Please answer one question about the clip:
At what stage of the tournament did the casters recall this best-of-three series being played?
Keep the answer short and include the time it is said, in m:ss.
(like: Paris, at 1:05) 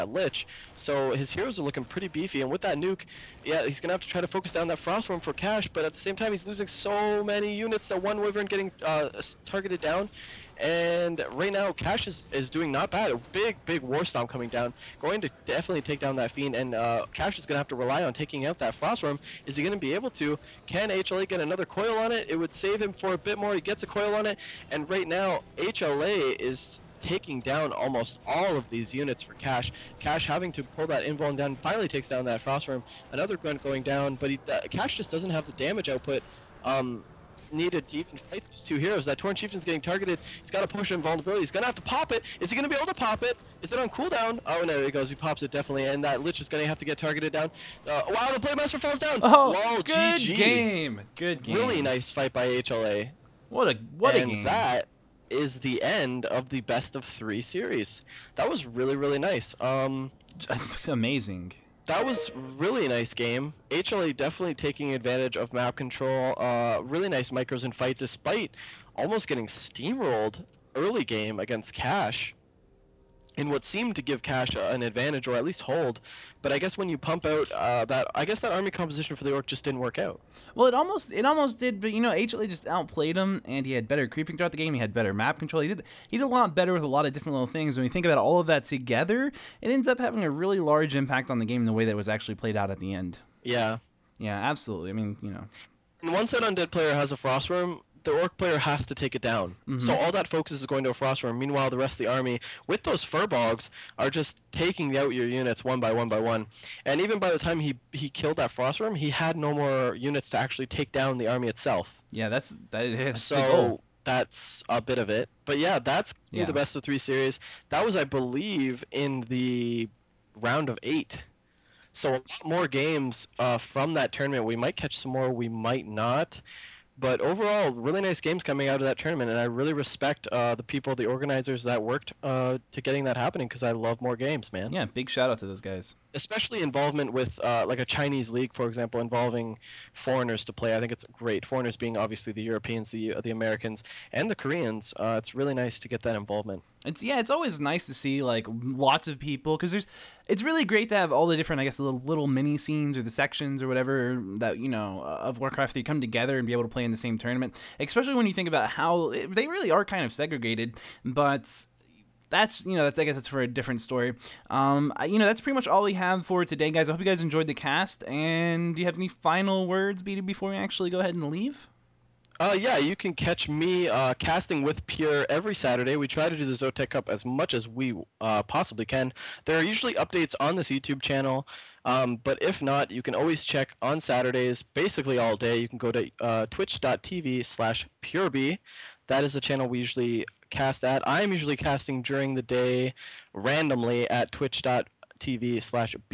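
Round of eight, at 2:00.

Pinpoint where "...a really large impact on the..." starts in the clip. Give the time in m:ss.
1:30.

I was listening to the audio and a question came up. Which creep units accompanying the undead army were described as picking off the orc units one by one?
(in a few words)
Furbolgs.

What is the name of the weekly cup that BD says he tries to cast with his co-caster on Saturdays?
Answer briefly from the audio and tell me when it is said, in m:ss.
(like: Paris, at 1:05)
Zotac Cup, at 2:56.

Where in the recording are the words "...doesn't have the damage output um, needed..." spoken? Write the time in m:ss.
0:35.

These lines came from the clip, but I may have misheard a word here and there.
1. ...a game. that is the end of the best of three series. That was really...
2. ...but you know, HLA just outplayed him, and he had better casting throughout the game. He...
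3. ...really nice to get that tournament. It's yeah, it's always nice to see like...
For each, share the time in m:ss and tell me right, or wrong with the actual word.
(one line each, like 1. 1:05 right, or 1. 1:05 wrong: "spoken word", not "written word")
1. 0:54 right
2. 1:21 wrong: "creeping", not "casting"
3. 2:25 wrong: "involvement", not "tournament".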